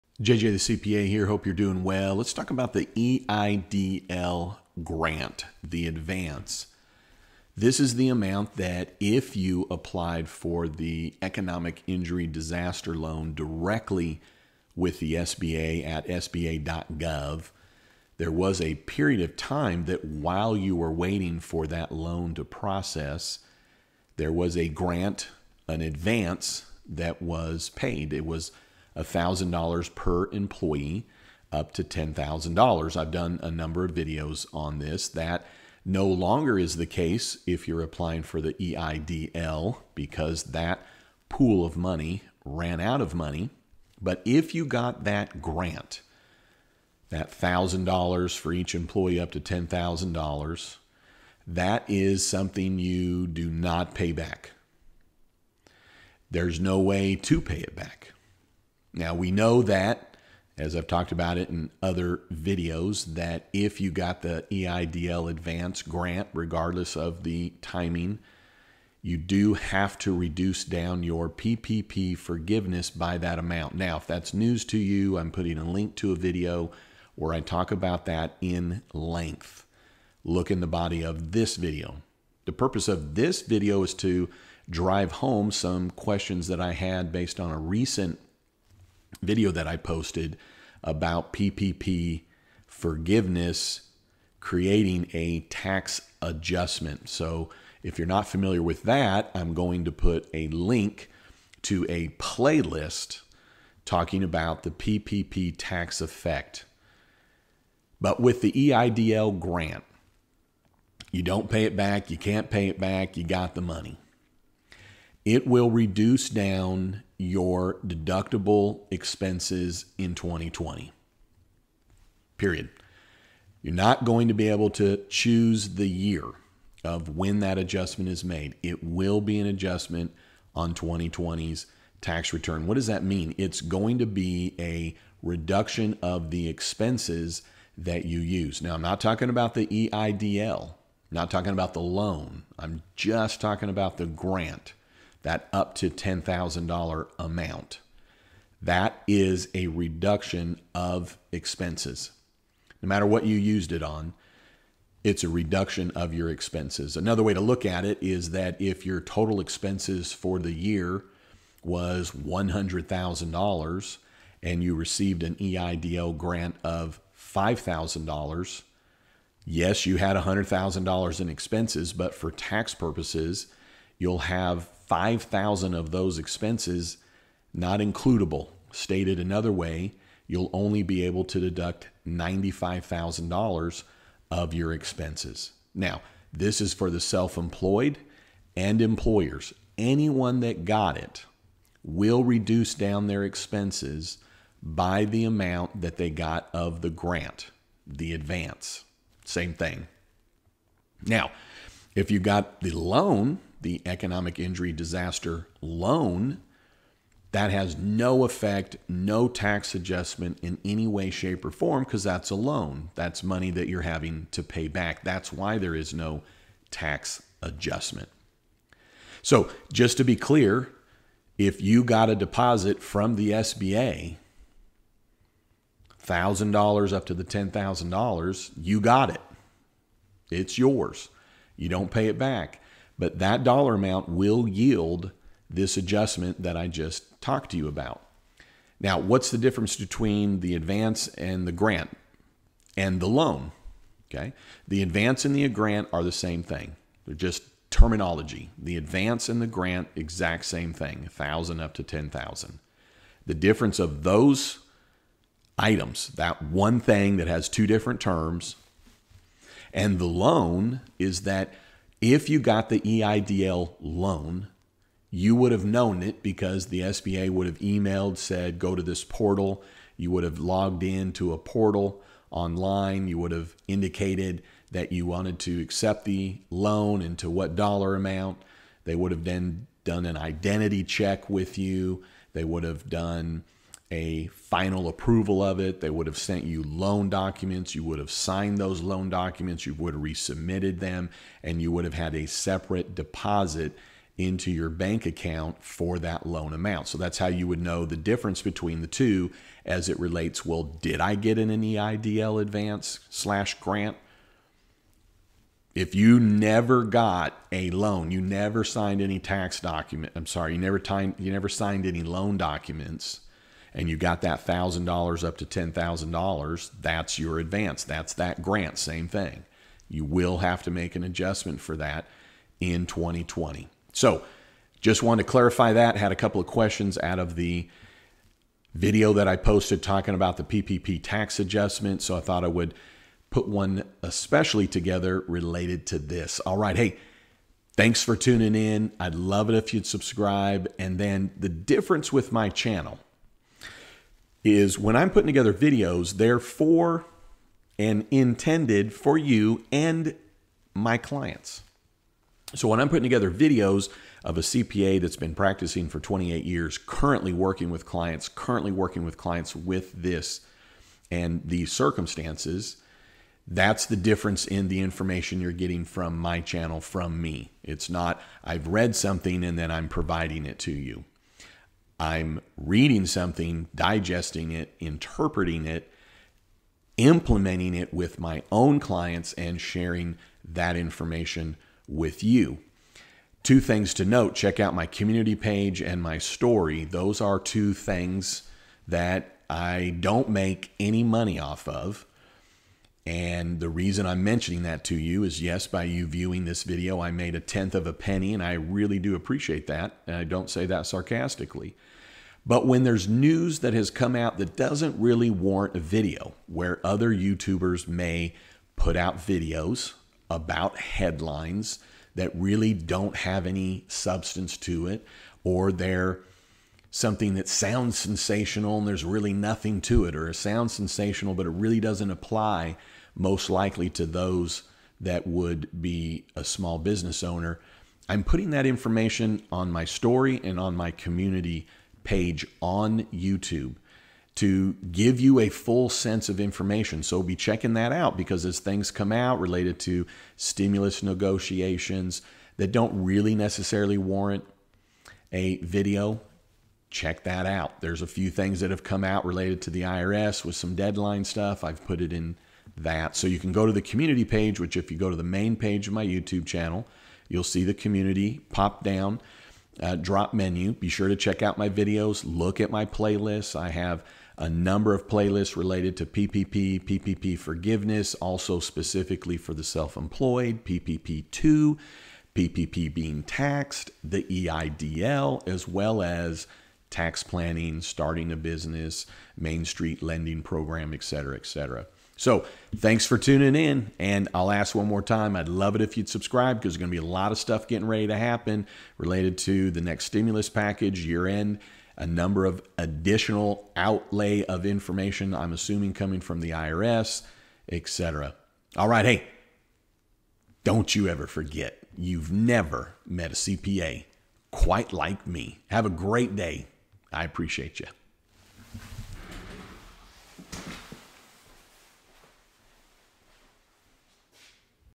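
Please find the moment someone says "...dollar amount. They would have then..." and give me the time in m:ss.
4:37.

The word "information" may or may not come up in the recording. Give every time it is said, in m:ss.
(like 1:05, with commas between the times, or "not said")
6:04, 6:20, 7:08, 7:16, 8:14.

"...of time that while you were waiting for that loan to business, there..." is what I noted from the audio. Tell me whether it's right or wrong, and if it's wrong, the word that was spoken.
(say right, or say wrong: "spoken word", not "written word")
wrong: "process", not "business".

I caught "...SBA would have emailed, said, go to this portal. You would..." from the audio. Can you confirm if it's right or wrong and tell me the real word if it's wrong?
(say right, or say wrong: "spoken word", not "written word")
right.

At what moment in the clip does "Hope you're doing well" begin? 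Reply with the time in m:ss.
0:01.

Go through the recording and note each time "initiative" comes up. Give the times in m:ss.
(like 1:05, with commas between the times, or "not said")
not said.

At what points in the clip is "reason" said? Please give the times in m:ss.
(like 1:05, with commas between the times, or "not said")
6:33.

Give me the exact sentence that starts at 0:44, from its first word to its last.
But if you got that grant, that $1,000 for each employee up to $10,000, that is something you do not pay back.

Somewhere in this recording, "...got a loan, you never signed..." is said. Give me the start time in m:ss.
5:06.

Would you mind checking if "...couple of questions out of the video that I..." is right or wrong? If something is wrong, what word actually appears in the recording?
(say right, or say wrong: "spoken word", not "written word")
right.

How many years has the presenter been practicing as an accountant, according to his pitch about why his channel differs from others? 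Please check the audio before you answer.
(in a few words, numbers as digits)
28.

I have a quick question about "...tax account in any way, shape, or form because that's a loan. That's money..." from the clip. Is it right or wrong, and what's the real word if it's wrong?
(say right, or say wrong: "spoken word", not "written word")
wrong: "adjustment", not "account".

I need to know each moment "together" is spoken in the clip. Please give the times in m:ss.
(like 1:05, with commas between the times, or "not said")
5:34, 5:45, 5:53.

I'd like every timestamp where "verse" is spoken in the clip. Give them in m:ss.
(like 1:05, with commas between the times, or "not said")
not said.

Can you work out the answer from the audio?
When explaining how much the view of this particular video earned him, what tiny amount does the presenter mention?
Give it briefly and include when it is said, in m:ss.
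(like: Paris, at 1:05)
A tenth of a penny, at 6:37.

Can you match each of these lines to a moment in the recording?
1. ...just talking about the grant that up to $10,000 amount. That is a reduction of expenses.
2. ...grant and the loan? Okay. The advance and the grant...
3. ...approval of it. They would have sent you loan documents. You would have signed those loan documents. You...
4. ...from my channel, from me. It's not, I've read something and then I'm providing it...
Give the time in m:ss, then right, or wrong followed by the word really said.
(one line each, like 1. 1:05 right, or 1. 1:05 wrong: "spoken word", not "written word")
1. 2:22 right
2. 4:01 right
3. 4:44 right
4. 6:05 right.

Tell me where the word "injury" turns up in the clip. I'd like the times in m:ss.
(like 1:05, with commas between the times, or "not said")
0:11, 3:24.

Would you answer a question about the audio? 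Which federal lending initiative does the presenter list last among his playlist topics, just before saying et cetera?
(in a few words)
Main Street lending program.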